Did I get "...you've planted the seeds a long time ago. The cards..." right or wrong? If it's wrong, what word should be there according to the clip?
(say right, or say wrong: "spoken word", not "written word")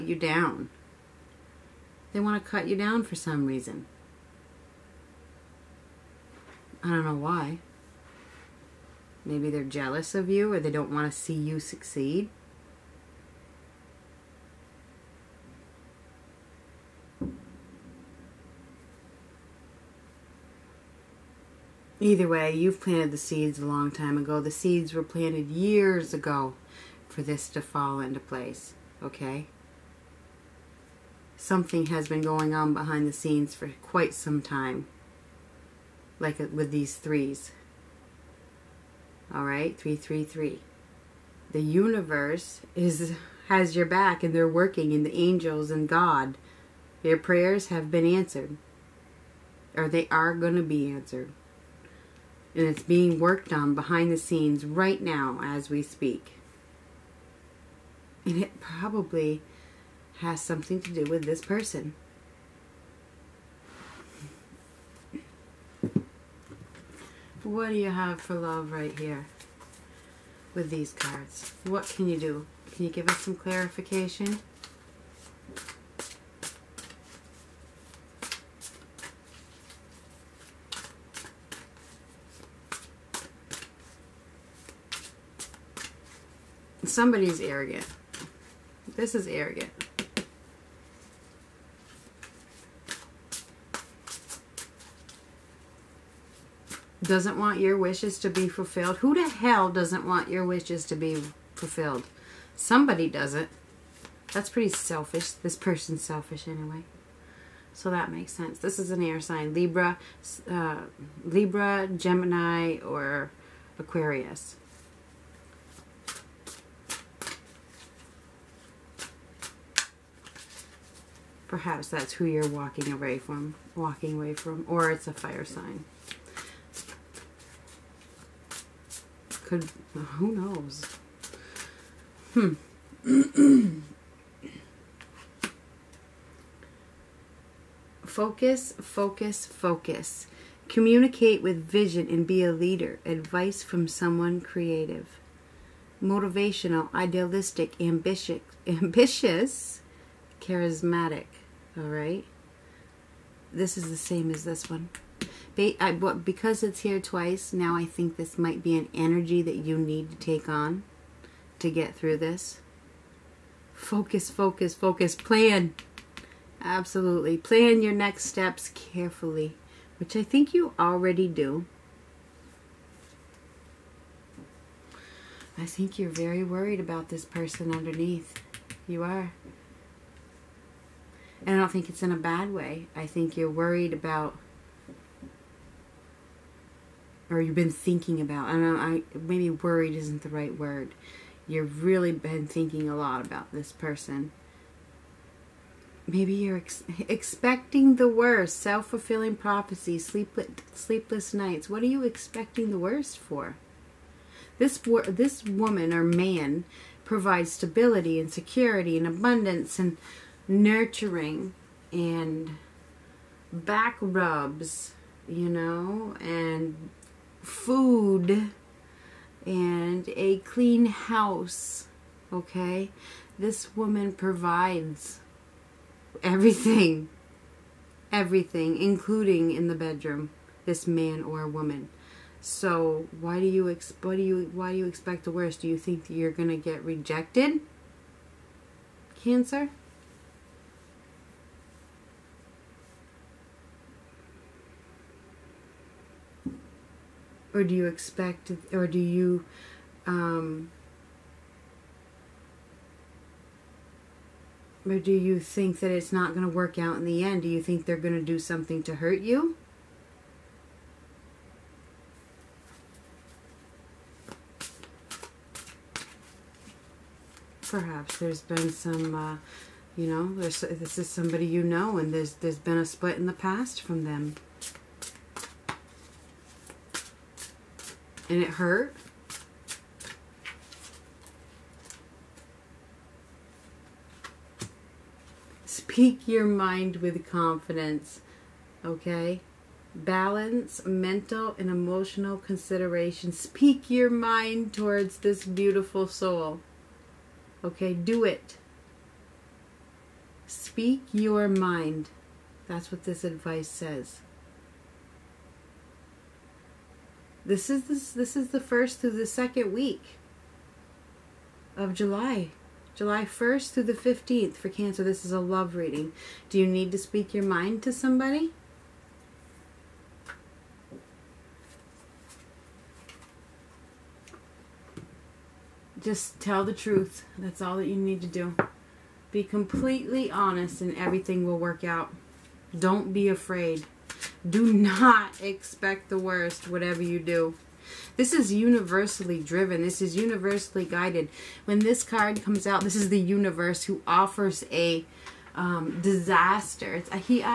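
wrong: "seeds", not "cards".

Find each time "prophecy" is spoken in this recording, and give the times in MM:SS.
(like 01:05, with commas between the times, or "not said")
03:19.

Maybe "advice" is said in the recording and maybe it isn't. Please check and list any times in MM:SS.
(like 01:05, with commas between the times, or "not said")
02:23, 05:03.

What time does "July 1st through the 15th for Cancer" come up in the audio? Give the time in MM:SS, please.
05:12.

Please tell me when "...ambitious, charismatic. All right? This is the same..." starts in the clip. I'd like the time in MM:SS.
02:28.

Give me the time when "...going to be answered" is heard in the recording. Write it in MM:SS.
00:50.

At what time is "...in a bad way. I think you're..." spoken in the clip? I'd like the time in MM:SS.
03:02.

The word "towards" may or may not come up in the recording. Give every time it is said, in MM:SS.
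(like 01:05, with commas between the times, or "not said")
04:54.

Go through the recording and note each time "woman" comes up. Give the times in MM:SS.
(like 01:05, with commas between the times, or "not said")
03:25, 03:43, 03:51.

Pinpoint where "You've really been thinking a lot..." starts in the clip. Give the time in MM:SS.
03:11.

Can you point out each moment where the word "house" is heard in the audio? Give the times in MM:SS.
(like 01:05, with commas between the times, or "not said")
03:40.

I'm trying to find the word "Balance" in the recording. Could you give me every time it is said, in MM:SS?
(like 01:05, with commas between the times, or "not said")
04:49.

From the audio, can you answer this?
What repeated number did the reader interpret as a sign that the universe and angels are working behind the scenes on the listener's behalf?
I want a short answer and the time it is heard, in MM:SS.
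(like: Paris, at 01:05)
333, at 00:39.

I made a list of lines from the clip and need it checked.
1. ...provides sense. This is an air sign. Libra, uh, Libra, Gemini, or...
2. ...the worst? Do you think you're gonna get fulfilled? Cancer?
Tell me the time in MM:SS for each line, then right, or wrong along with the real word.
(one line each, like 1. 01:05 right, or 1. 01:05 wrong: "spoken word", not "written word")
1. 01:48 wrong: "makes", not "provides"
2. 03:55 wrong: "rejected", not "fulfilled".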